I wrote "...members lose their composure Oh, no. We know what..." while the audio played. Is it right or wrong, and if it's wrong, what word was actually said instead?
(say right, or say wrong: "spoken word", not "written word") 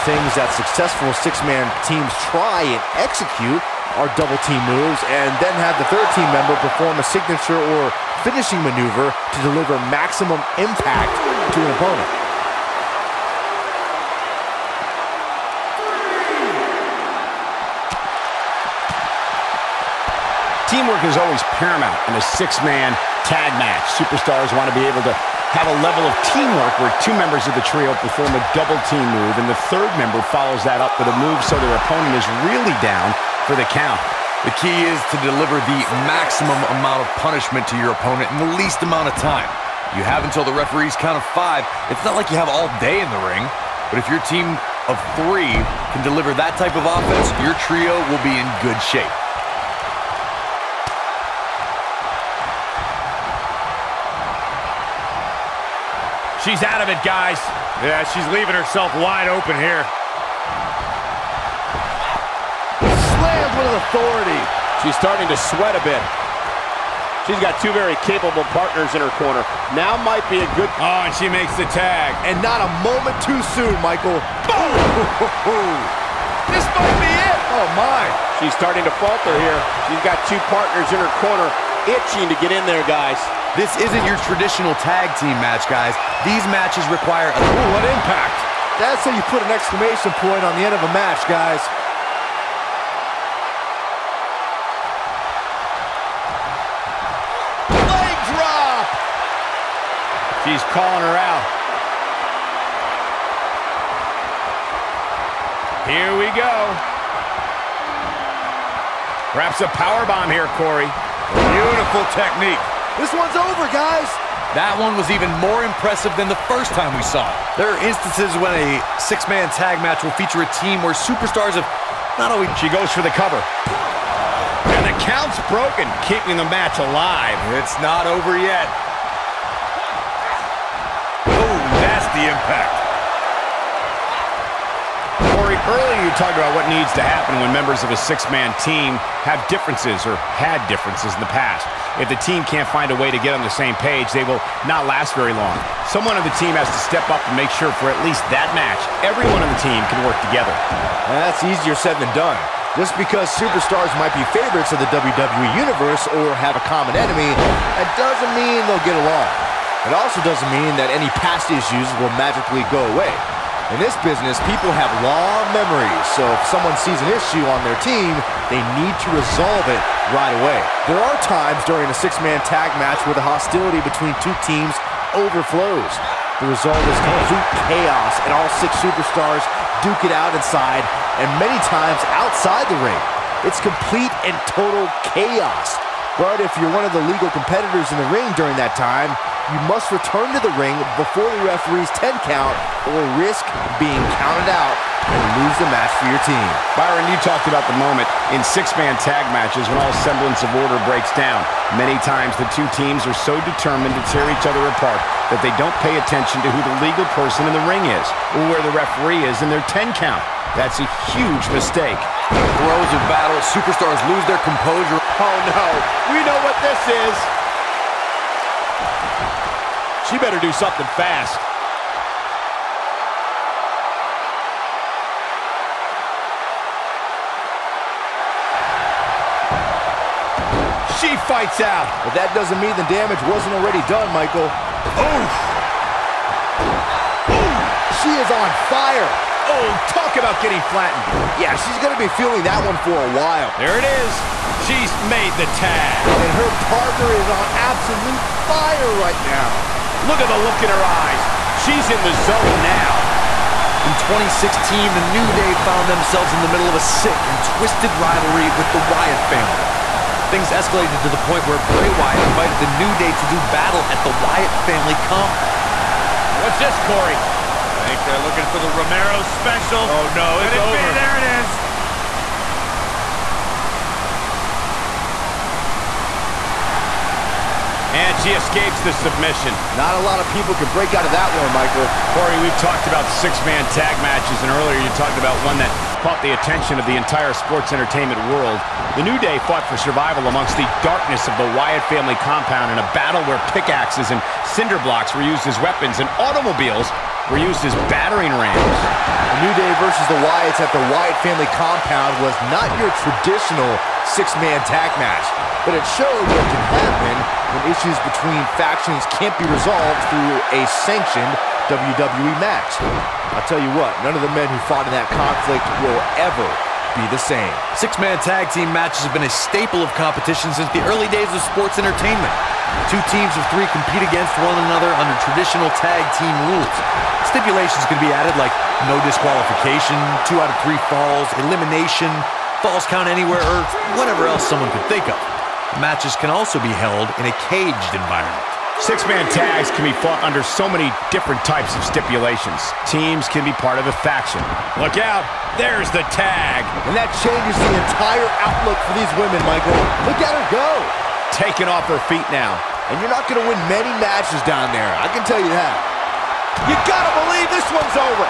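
wrong: "superstars", not "members".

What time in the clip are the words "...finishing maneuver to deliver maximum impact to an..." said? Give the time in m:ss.
0:08.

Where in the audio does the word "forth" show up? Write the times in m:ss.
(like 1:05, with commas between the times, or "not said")
not said.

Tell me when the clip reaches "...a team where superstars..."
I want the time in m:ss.
2:00.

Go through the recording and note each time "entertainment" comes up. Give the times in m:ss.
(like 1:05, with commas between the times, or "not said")
4:47, 5:21.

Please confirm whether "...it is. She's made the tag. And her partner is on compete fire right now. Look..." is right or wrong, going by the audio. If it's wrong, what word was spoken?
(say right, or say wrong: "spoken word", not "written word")
wrong: "absolute", not "compete".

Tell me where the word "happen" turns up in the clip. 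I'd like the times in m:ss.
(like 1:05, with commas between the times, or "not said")
2:17, 5:06.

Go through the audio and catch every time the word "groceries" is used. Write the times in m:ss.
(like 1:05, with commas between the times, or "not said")
not said.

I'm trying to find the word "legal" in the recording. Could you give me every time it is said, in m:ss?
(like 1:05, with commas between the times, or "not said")
3:07, 3:26.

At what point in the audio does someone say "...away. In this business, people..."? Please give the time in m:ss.
2:42.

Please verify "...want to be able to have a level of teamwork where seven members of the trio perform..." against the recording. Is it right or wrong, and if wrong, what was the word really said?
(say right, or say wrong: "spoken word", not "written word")
wrong: "two", not "seven".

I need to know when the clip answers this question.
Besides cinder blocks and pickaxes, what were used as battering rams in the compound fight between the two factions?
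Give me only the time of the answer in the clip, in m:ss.
4:56.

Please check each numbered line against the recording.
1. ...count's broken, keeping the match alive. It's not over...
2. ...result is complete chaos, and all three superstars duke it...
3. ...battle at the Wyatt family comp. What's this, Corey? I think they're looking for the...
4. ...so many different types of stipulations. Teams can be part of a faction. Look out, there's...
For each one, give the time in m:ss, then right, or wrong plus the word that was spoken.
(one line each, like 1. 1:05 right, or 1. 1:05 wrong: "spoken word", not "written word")
1. 2:05 right
2. 2:56 wrong: "six", not "three"
3. 4:23 right
4. 5:40 right.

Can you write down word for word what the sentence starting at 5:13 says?
I'll tell you what, none of the men who fought in that conflict will ever be the same.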